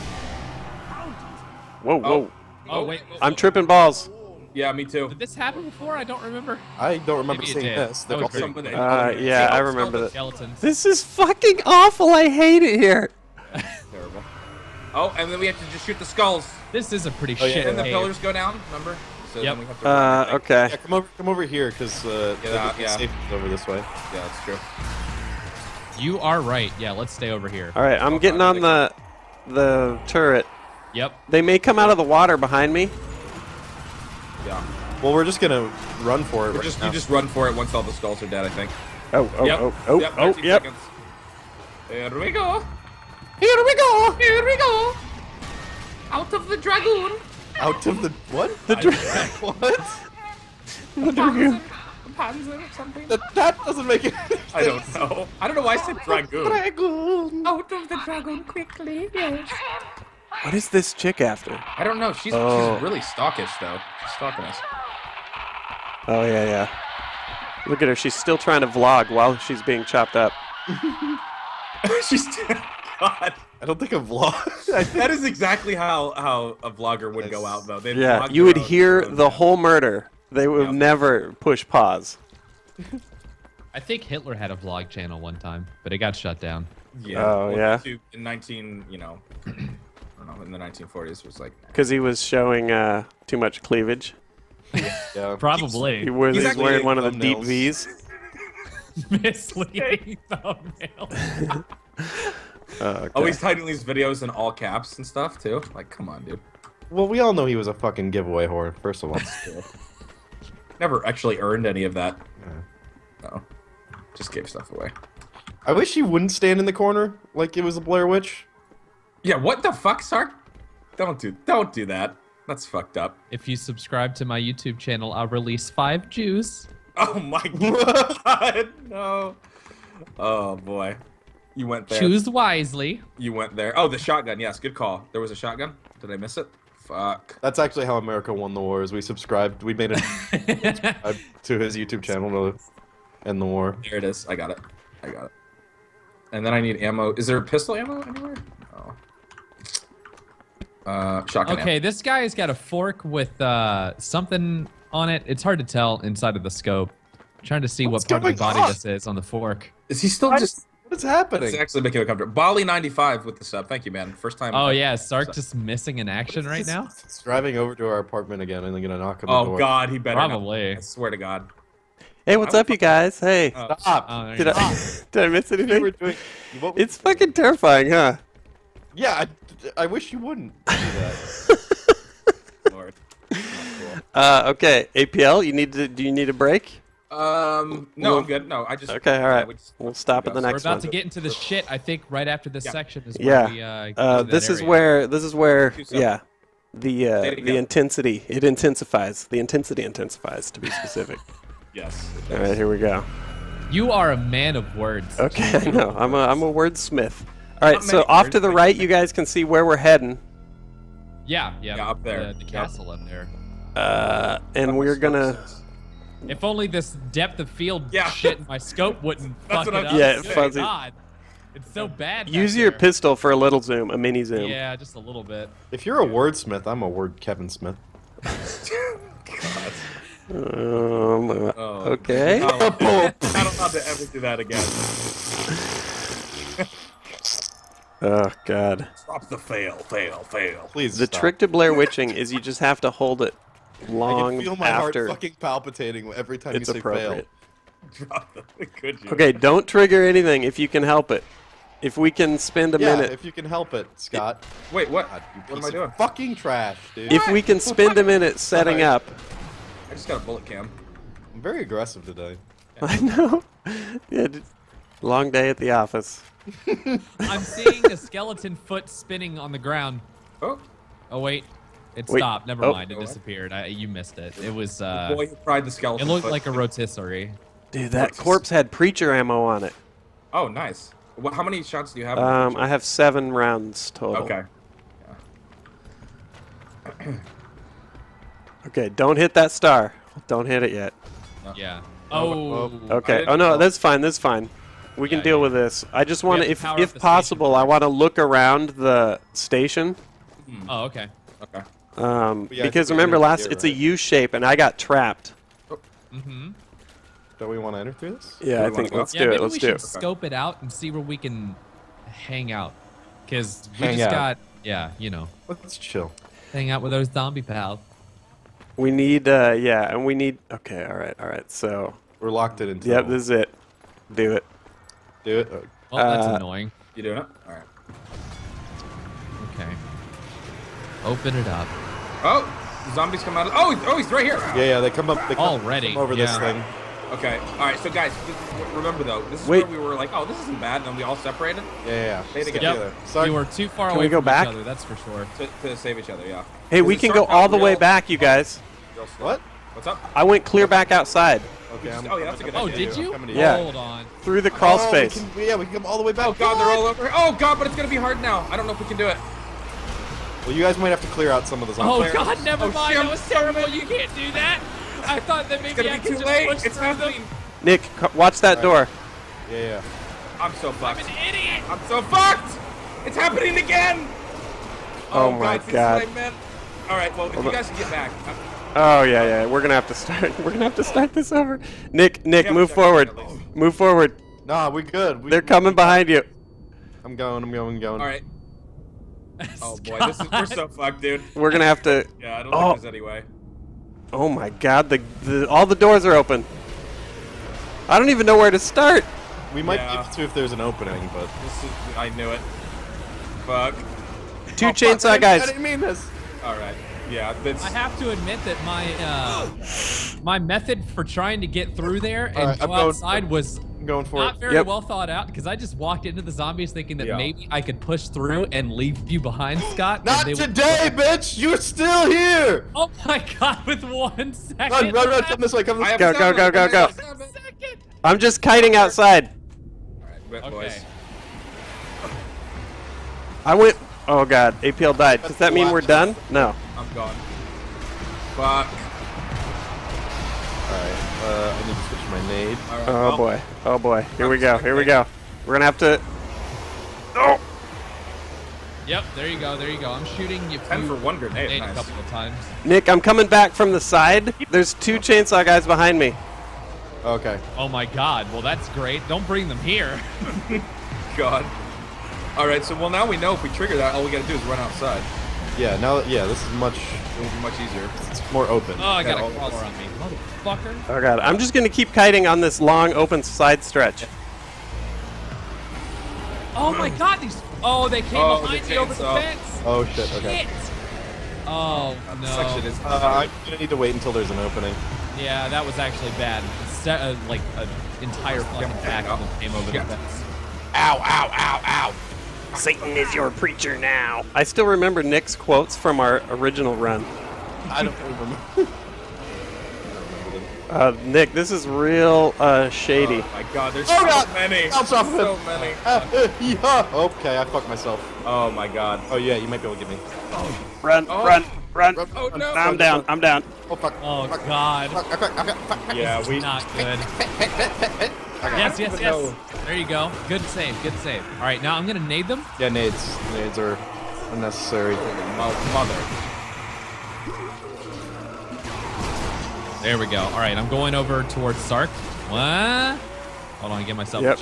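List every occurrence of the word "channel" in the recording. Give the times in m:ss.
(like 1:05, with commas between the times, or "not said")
1:24, 2:04, 2:22.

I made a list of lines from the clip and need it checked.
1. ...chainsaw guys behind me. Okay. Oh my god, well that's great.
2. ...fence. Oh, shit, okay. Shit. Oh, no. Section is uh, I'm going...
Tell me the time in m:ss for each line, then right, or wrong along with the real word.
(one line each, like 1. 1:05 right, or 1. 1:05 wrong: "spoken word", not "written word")
1. 7:34 right
2. 7:59 right.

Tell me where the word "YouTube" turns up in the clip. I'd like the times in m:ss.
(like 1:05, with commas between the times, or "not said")
2:04, 2:21.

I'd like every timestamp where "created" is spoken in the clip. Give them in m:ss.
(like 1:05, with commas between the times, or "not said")
not said.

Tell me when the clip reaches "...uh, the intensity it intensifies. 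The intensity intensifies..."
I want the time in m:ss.
3:17.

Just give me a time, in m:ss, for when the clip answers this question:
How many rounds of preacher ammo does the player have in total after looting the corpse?
4:42.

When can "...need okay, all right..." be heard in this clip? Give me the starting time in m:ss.
5:20.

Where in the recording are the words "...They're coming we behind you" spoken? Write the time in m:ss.
6:25.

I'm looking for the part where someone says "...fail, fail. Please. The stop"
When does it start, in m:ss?
3:59.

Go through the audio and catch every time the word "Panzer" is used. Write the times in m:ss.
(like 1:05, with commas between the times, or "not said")
0:52.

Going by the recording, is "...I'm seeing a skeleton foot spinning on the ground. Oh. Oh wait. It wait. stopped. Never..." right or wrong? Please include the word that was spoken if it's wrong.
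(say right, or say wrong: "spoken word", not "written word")
right.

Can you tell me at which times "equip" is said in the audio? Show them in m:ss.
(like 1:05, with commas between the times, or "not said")
not said.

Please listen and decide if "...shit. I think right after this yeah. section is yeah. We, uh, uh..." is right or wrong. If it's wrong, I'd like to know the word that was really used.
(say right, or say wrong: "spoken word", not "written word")
right.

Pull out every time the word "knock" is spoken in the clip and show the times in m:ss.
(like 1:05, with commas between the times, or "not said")
2:48.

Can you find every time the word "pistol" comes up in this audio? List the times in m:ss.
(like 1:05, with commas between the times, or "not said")
2:27, 3:42.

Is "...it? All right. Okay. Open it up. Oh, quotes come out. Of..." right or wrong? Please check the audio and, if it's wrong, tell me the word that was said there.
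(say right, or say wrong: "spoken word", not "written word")
wrong: "zombies", not "quotes".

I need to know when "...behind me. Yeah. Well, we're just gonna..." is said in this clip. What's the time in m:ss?
0:32.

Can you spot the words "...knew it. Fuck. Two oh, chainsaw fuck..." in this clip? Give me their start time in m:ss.
6:42.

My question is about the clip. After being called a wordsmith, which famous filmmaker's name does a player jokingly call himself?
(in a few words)
Kevin Smith.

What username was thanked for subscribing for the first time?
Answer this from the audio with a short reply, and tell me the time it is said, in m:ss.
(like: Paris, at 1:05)
Bali ninety five, at 2:42.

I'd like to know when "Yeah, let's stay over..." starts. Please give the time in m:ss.
0:26.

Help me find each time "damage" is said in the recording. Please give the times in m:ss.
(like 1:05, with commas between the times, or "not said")
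not said.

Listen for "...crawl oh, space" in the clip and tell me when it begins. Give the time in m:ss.
5:54.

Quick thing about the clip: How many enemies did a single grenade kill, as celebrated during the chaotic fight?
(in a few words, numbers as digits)
10.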